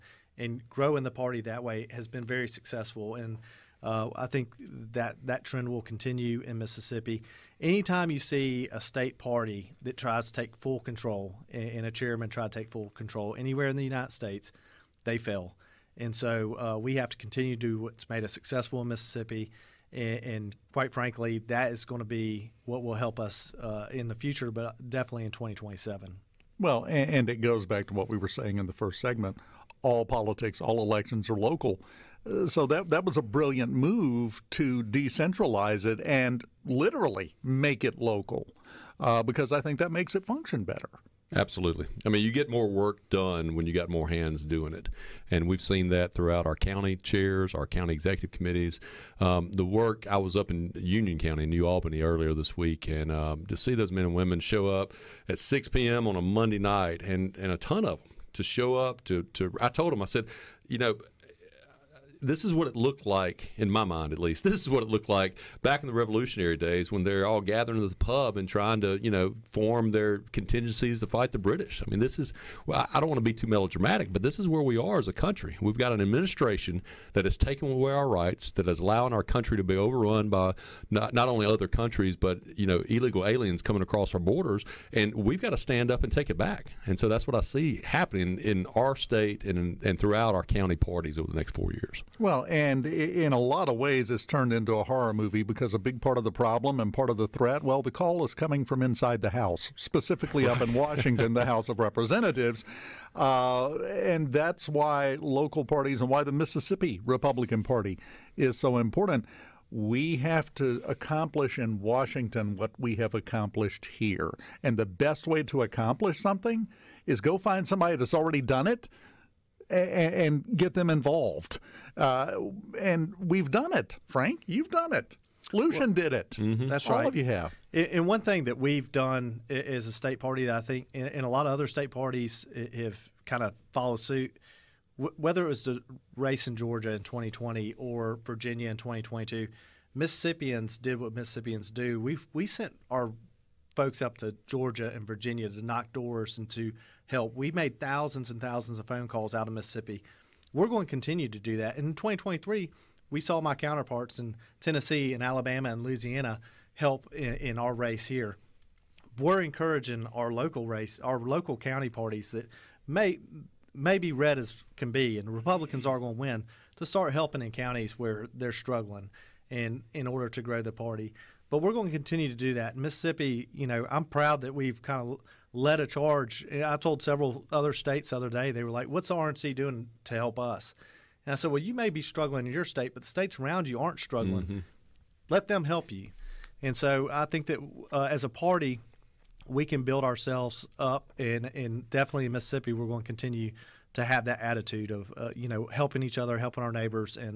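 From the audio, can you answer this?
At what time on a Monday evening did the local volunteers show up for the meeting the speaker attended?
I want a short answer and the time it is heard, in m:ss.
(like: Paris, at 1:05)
6 p.m., at 0:55.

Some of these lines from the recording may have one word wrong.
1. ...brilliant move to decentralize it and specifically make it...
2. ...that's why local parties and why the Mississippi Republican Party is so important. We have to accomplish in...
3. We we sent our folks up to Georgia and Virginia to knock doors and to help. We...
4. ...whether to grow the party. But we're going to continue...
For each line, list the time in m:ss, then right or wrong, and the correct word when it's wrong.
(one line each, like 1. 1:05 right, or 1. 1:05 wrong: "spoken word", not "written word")
1. 0:33 wrong: "literally", not "specifically"
2. 1:44 right
3. 2:21 right
4. 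2:50 wrong: "order", not "whether".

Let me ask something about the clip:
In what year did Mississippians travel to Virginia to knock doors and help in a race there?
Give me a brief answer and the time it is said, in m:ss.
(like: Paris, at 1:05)
2022, at 2:18.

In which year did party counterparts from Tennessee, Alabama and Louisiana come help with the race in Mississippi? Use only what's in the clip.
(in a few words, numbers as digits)
2023.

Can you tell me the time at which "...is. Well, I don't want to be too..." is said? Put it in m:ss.
1:12.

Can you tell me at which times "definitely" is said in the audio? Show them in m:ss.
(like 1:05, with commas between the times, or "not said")
0:24, 3:11.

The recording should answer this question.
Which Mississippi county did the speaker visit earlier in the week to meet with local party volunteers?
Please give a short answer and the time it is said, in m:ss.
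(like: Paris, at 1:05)
Union County, at 0:50.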